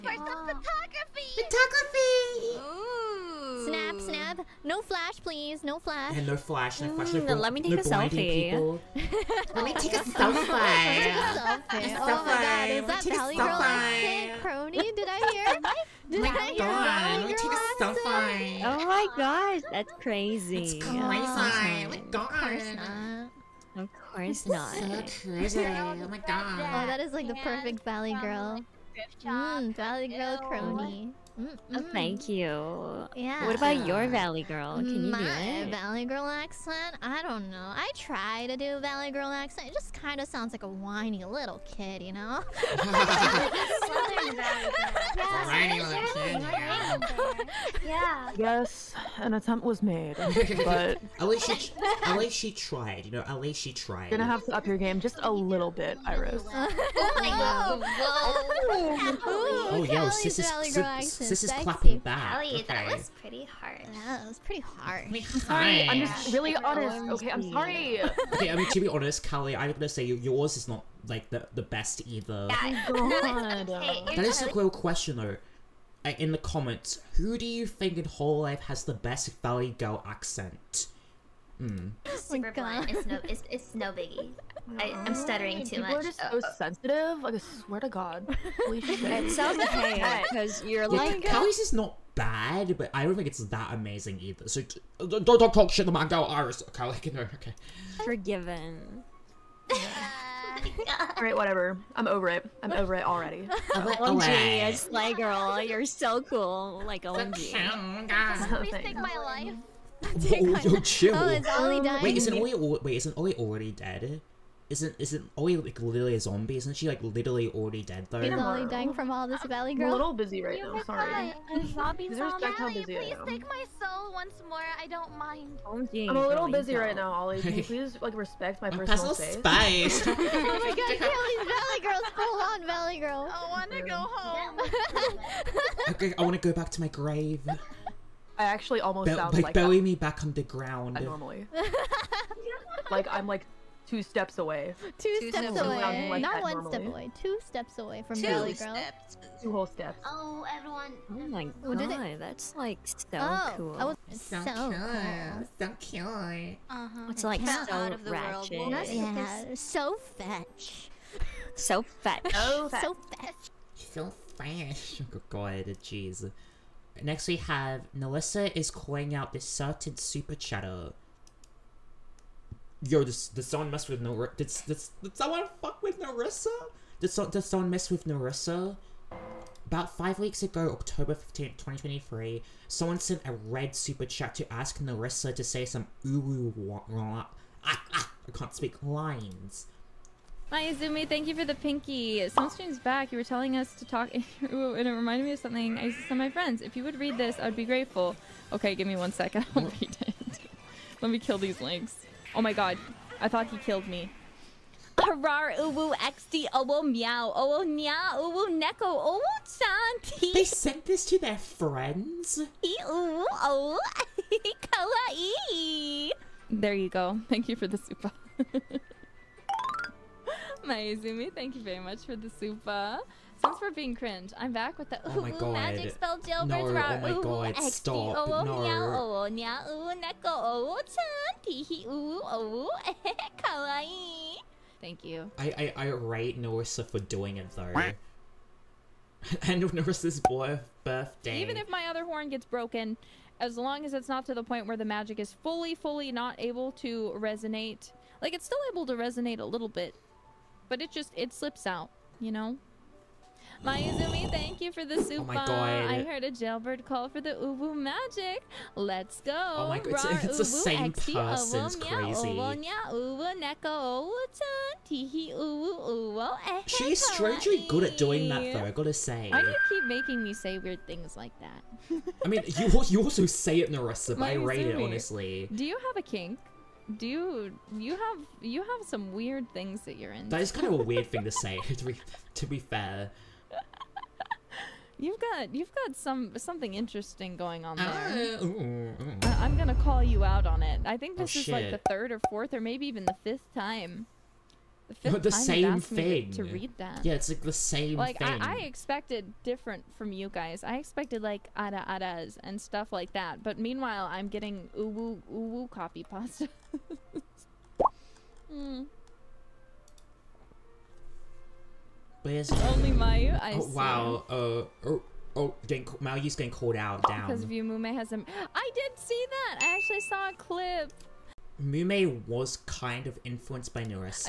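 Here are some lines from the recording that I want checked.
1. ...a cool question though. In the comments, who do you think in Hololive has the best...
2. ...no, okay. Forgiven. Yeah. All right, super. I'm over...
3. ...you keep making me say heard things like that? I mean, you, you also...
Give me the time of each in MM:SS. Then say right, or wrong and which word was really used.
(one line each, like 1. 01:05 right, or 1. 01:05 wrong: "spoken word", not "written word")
1. 01:14 right
2. 01:37 wrong: "whatever", not "super"
3. 04:29 wrong: "weird", not "heard".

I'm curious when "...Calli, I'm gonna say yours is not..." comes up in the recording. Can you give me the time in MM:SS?
01:09.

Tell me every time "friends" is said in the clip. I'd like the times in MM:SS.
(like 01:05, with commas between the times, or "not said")
03:16, 03:31.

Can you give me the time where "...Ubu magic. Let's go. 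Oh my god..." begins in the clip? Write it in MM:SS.
04:17.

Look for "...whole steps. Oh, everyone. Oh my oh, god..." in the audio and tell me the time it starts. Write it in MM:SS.
02:29.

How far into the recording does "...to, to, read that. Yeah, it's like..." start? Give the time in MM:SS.
04:56.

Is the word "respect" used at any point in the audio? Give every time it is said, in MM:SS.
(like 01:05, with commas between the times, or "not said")
02:02, 02:08.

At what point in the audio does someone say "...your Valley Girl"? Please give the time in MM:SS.
00:33.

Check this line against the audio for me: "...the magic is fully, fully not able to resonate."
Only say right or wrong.
right.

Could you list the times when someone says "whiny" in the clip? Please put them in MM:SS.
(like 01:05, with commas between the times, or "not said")
00:40, 00:45.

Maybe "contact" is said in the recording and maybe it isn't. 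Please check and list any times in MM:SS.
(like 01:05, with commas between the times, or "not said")
not said.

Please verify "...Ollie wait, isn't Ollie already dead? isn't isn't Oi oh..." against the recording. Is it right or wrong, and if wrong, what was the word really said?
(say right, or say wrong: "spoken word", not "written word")
right.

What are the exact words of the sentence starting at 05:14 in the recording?
Uh, oh, oh, getting Mayu's getting called out down.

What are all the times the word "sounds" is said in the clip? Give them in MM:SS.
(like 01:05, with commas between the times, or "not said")
00:40, 01:29, 02:19.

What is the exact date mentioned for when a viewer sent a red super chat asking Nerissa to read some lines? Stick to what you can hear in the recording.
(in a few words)
October 15th, 2023.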